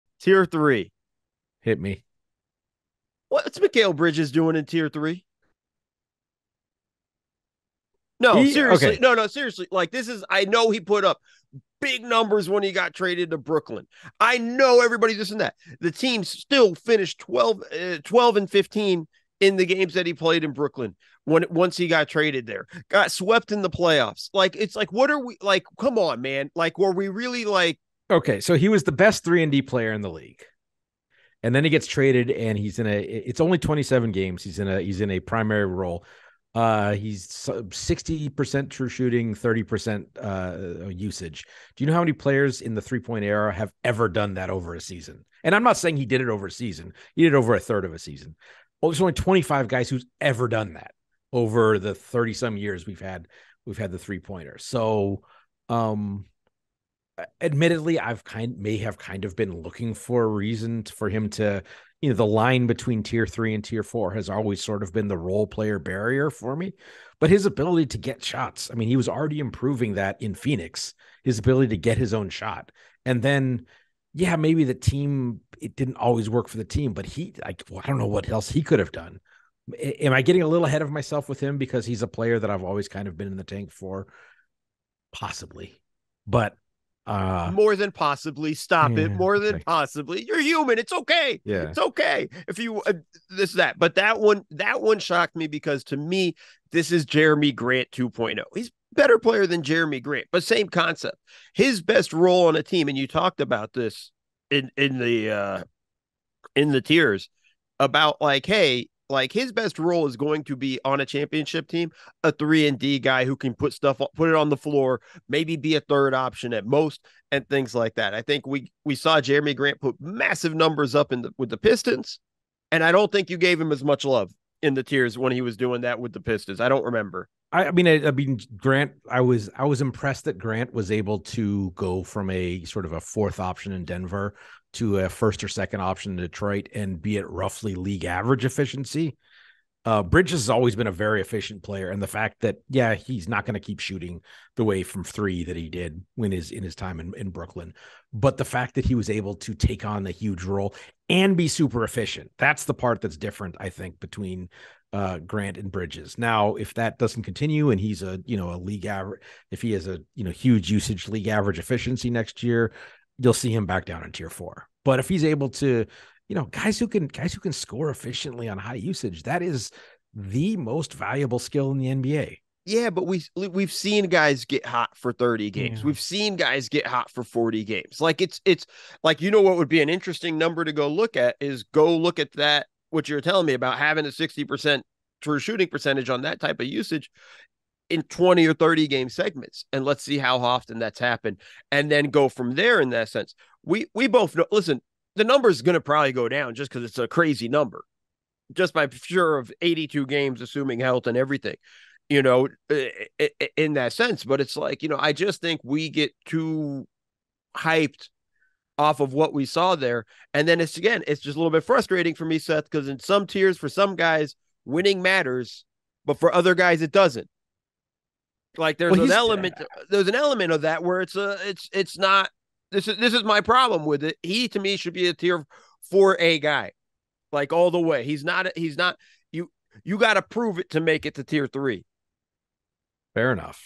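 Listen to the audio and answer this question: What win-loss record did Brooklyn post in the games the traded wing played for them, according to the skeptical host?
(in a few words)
12-15.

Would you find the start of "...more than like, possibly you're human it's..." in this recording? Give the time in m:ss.
1:29.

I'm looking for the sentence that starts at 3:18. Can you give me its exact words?
Just by sure of 82 games assuming health and everything you know, uh, in that sense.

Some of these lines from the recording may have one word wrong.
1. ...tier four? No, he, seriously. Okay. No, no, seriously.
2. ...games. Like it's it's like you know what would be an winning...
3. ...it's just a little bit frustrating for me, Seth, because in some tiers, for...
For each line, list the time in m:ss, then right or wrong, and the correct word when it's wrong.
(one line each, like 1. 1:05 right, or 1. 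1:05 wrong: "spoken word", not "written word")
1. 0:04 wrong: "three", not "four"
2. 2:57 wrong: "interesting", not "winning"
3. 3:31 right.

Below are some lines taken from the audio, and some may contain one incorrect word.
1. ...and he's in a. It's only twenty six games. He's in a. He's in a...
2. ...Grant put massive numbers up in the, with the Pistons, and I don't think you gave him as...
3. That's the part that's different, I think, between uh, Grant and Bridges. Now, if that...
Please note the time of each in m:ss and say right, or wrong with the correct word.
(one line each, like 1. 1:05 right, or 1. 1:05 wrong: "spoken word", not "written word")
1. 0:32 wrong: "seven", not "six"
2. 1:59 right
3. 2:32 right.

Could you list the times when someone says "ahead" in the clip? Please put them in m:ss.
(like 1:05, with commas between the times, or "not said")
1:20.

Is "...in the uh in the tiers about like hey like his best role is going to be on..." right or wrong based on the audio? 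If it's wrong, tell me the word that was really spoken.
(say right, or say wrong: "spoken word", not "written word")
right.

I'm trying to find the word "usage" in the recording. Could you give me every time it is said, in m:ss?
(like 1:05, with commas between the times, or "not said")
0:40, 2:40, 2:48, 3:06.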